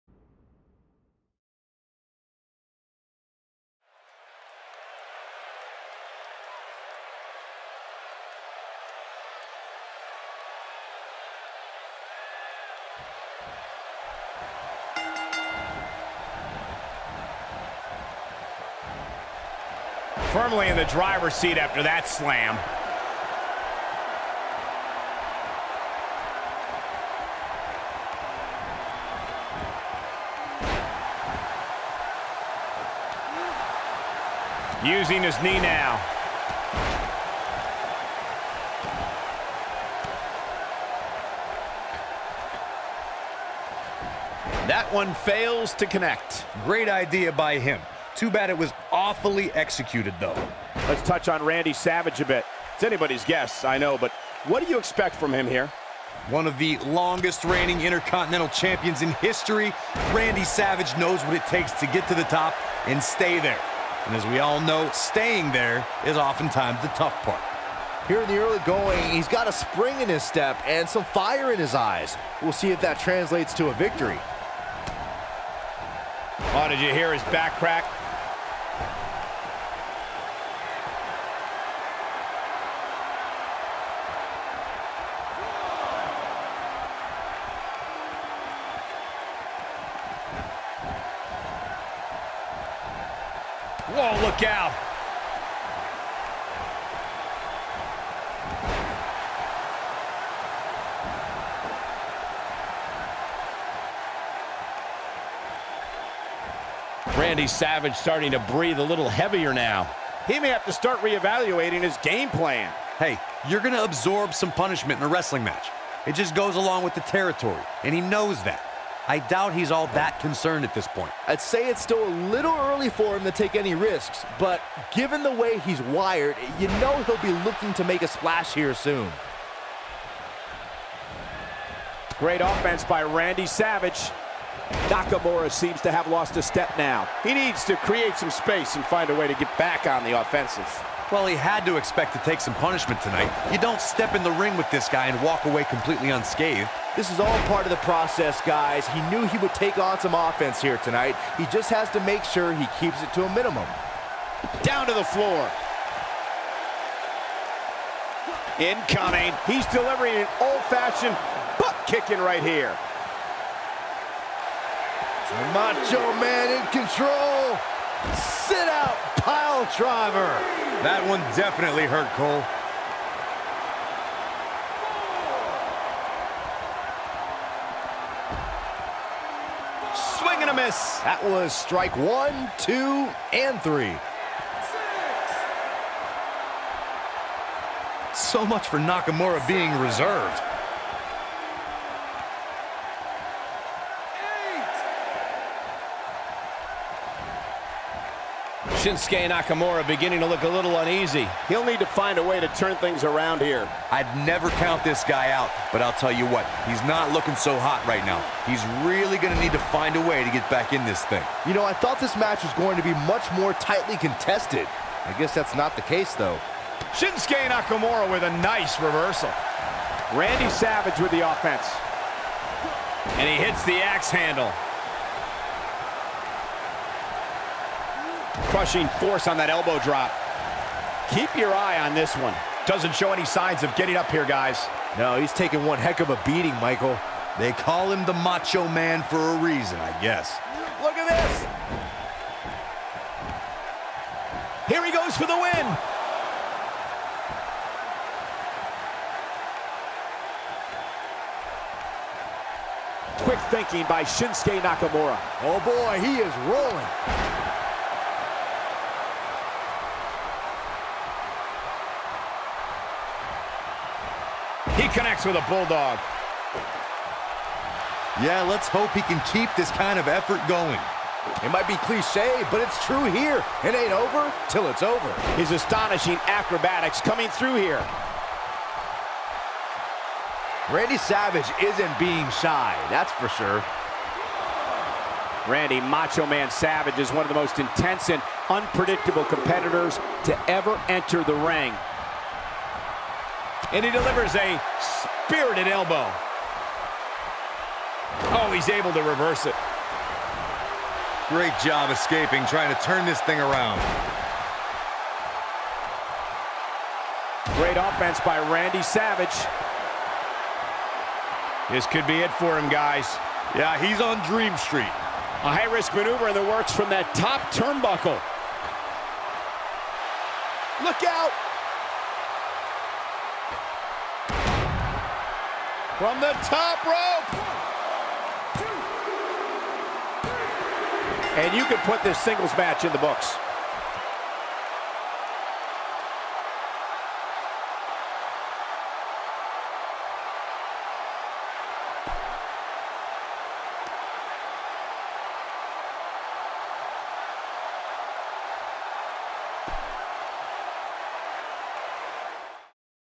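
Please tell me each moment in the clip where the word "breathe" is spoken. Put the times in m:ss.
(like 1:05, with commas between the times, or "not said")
1:48.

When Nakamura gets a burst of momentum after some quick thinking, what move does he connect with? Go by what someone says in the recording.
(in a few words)
Bulldog.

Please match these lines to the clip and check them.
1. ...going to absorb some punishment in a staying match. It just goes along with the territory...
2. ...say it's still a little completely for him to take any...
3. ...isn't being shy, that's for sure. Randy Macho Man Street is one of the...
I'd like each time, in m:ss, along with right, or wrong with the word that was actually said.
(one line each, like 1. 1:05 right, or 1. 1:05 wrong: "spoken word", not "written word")
1. 1:53 wrong: "wrestling", not "staying"
2. 2:01 wrong: "early", not "completely"
3. 4:41 wrong: "Savage", not "Street".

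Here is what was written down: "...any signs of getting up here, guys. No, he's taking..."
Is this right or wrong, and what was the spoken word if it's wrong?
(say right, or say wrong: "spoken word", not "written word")
right.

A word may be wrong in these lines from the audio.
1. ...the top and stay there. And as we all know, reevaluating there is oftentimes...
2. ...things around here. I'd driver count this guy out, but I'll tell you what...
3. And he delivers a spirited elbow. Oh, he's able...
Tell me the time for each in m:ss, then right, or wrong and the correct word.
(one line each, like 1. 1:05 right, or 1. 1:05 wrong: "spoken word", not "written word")
1. 1:02 wrong: "staying", not "reevaluating"
2. 3:22 wrong: "never", not "driver"
3. 4:53 right.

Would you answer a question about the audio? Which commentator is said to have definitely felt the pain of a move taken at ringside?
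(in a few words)
Cole.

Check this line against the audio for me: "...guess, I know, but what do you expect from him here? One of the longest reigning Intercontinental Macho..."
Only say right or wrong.
wrong.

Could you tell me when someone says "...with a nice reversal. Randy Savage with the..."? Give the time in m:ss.
3:38.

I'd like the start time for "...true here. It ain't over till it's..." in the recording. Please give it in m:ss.
4:32.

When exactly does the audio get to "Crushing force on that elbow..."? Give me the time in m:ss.
3:48.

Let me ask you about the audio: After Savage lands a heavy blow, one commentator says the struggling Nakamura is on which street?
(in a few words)
Dream Street.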